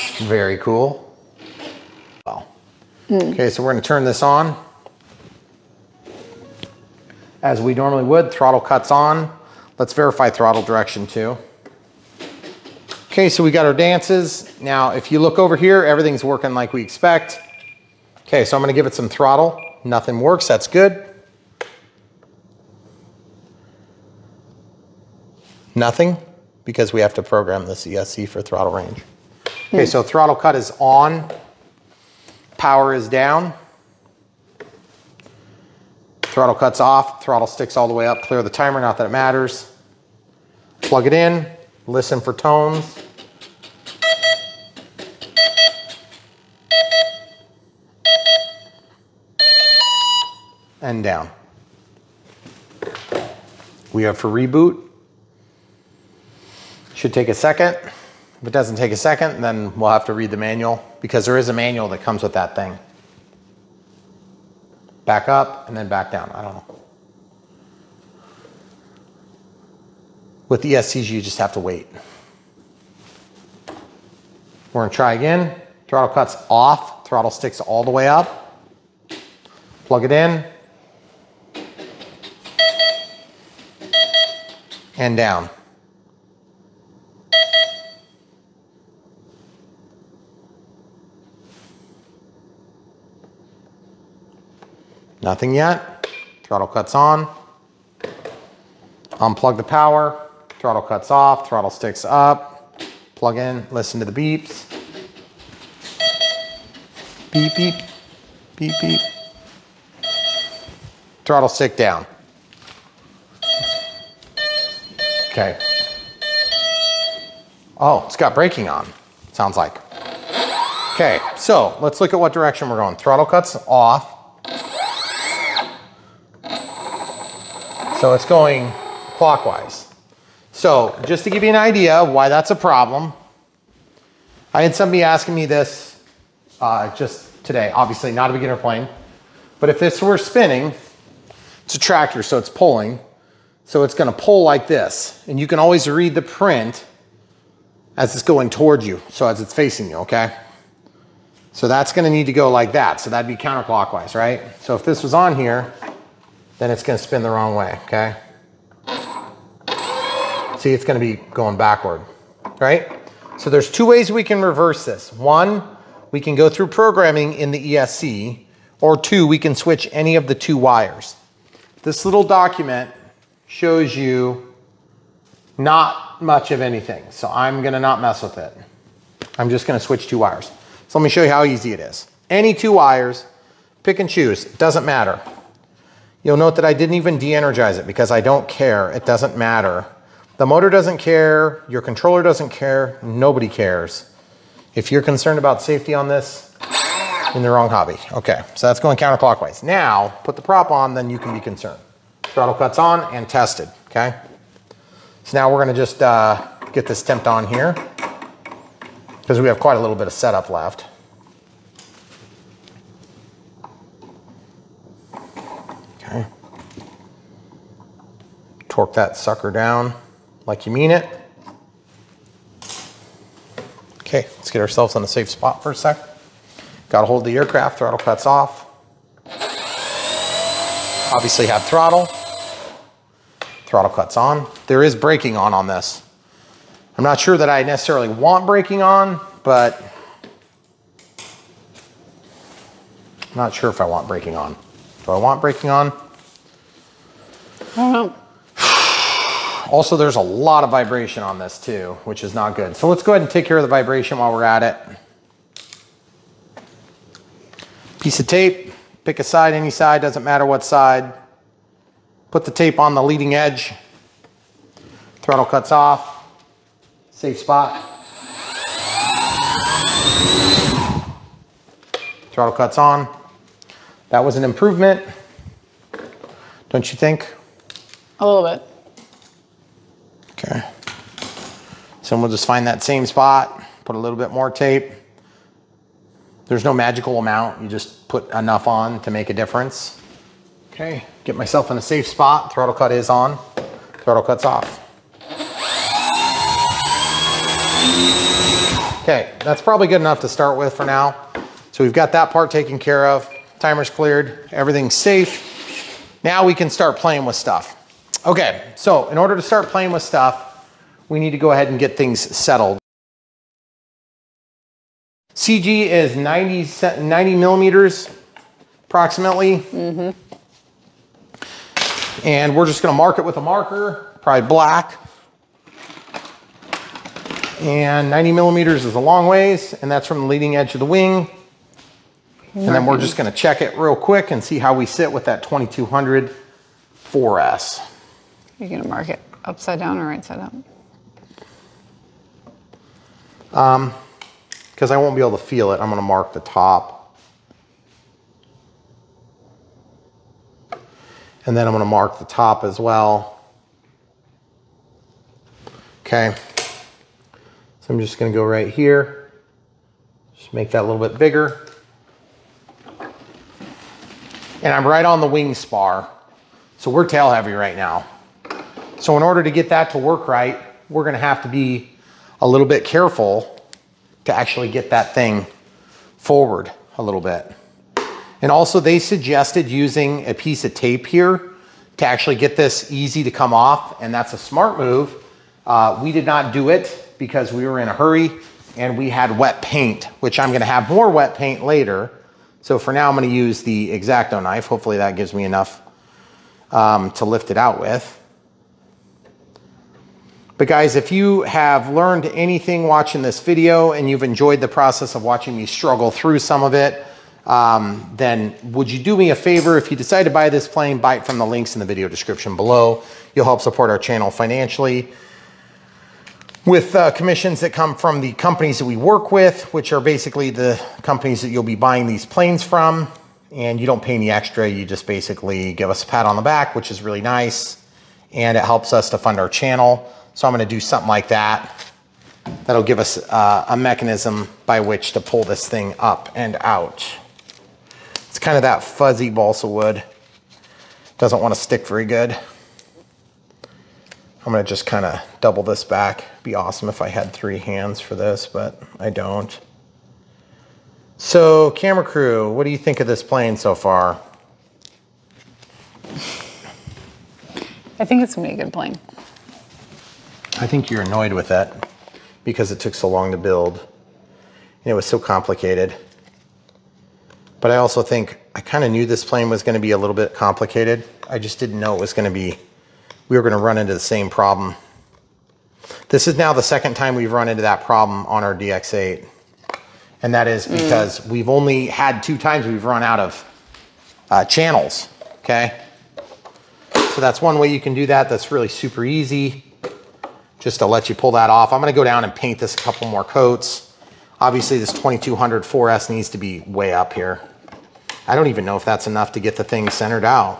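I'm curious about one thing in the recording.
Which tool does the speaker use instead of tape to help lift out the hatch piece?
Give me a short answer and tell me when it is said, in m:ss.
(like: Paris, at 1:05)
X-Acto knife, at 6:33.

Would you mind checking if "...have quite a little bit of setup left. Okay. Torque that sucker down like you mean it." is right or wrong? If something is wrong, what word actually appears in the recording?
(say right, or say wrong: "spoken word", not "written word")
right.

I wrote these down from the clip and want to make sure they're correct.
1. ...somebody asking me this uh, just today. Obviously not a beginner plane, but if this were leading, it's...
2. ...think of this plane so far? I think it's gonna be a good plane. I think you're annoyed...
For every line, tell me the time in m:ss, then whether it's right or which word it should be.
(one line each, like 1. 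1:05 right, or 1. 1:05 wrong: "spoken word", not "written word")
1. 2:14 wrong: "spinning", not "leading"
2. 7:32 right.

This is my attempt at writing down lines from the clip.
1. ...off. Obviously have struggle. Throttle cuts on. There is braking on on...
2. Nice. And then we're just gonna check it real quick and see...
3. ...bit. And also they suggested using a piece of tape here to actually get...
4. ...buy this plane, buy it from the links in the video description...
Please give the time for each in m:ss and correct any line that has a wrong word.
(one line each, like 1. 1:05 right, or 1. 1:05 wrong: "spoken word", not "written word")
1. 3:48 wrong: "throttle", not "struggle"
2. 5:31 right
3. 6:17 right
4. 6:50 right.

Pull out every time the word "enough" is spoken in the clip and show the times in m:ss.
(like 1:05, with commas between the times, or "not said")
4:48, 5:00, 6:35, 8:19.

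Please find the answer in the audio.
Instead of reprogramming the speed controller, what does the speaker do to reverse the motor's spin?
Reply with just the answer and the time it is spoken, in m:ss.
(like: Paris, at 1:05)
switch two wires, at 2:59.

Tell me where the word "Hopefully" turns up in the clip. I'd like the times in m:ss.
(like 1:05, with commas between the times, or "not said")
6:34.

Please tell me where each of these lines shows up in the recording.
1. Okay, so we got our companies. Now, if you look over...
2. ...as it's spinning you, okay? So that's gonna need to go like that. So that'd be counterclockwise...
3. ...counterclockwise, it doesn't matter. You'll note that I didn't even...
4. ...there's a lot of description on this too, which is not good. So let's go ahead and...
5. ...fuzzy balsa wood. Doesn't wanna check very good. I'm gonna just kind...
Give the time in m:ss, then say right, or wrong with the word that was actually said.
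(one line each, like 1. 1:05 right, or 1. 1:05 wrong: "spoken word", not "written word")
1. 0:13 wrong: "dances", not "companies"
2. 2:29 wrong: "facing", not "spinning"
3. 3:04 wrong: "choose", not "counterclockwise"
4. 4:09 wrong: "vibration", not "description"
5. 7:18 wrong: "stick", not "check".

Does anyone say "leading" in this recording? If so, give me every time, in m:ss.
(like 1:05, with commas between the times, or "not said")
4:23, 5:30.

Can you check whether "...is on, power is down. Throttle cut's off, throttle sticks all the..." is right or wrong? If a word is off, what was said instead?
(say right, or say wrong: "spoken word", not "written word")
right.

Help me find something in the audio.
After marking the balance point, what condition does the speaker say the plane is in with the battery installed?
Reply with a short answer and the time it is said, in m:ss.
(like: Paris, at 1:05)
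tail heavy, at 6:07.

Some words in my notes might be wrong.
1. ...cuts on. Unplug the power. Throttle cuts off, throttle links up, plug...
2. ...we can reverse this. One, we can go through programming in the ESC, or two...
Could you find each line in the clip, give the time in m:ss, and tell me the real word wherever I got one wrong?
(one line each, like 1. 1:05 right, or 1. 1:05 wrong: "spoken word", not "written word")
1. 1:36 wrong: "sticks", not "links"
2. 2:44 right.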